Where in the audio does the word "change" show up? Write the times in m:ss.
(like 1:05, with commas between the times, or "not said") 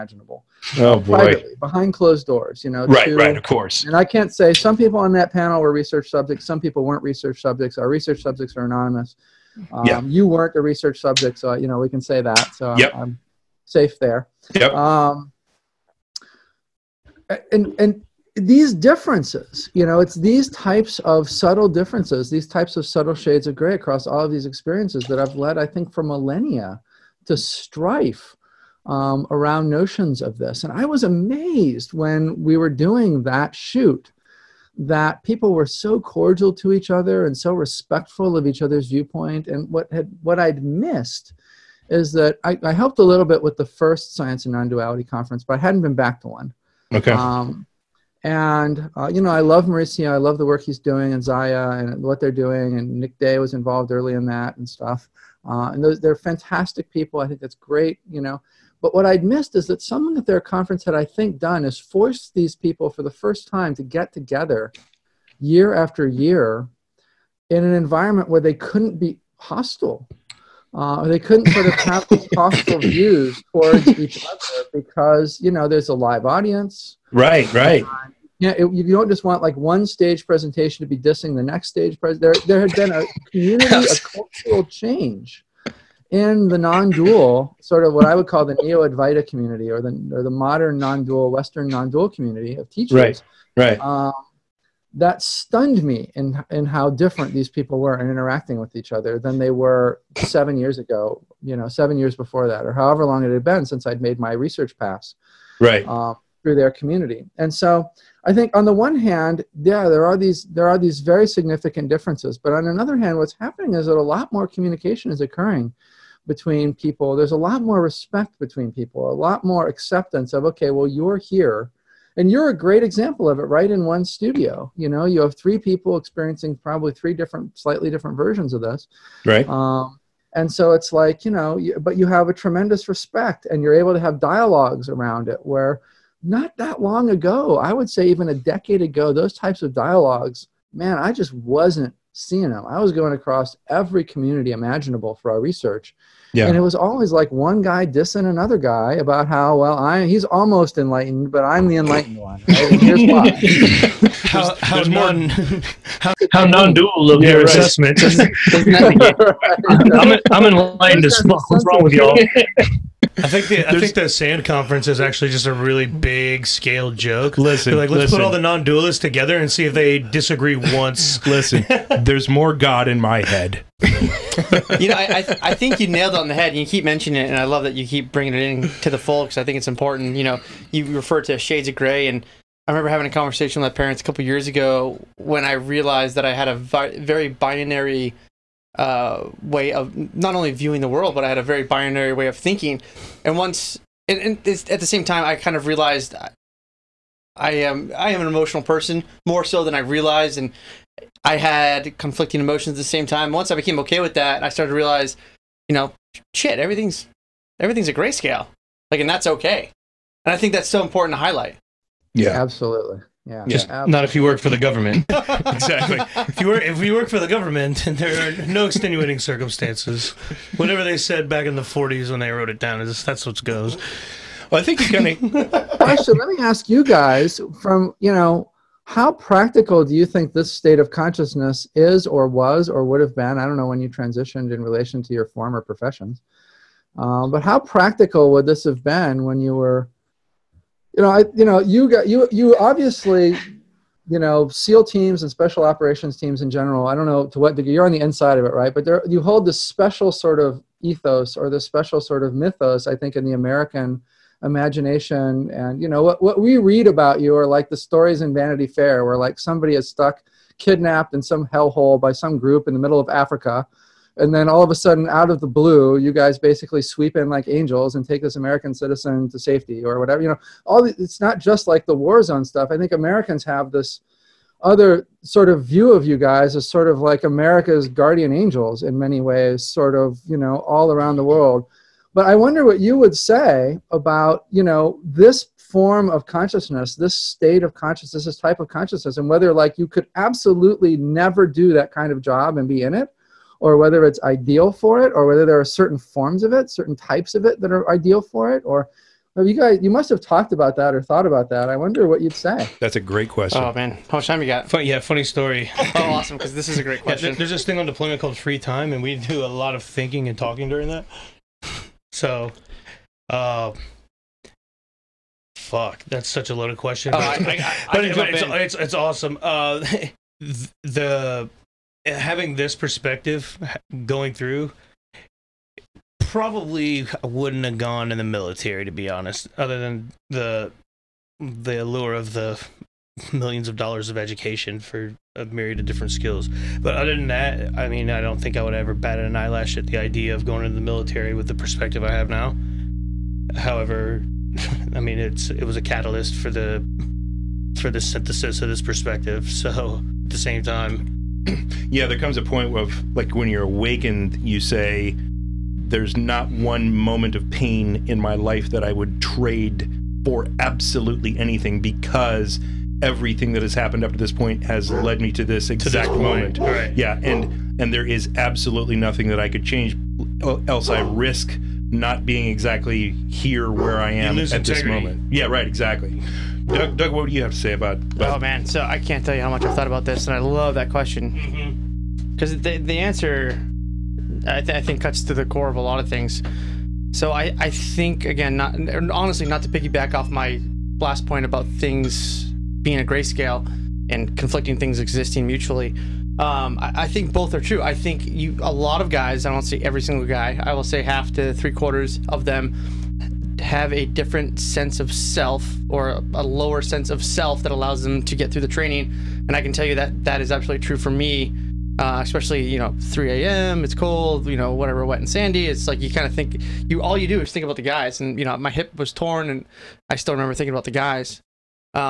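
1:24, 6:09.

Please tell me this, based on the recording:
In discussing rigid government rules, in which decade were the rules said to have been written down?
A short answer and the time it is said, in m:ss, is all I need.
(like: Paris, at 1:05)
the 40s, at 3:41.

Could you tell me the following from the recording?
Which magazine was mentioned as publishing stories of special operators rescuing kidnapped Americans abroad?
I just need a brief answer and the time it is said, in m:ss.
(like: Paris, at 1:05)
Vanity Fair, at 4:18.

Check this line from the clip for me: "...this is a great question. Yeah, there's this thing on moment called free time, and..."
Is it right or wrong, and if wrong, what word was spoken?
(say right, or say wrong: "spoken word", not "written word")
wrong: "deployment", not "moment".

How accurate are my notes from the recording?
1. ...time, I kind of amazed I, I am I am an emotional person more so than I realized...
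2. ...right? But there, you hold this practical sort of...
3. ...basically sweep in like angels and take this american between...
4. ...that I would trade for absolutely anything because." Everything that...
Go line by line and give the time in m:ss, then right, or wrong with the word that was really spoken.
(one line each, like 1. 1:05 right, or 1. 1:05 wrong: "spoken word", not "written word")
1. 3:15 wrong: "realized", not "amazed"
2. 4:08 wrong: "special", not "practical"
3. 4:26 wrong: "citizen", not "between"
4. 5:58 right.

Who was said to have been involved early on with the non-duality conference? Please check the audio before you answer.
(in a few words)
Nick Day.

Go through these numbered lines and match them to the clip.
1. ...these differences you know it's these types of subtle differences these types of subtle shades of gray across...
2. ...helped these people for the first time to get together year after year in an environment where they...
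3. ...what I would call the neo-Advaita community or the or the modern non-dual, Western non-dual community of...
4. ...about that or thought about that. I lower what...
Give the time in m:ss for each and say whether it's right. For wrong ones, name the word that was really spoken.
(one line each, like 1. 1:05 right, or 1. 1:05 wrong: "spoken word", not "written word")
1. 0:18 right
2. 1:01 wrong: "forced", not "helped"
3. 1:27 right
4. 5:00 wrong: "wonder", not "lower".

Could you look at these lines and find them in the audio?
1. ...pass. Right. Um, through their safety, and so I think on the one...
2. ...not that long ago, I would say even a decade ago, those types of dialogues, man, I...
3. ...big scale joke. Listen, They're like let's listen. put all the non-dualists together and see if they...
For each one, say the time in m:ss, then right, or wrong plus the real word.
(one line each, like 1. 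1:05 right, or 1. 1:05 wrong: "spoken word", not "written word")
1. 1:44 wrong: "community", not "safety"
2. 2:16 right
3. 2:45 right.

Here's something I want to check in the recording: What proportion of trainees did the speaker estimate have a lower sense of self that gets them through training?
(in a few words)
half to three quarters.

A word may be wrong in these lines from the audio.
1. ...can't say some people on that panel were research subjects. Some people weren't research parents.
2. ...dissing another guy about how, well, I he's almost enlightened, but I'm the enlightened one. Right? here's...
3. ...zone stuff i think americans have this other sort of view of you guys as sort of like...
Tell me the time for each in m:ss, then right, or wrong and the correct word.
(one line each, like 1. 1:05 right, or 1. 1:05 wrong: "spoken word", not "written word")
1. 0:04 wrong: "subjects", not "parents"
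2. 2:27 right
3. 4:32 right.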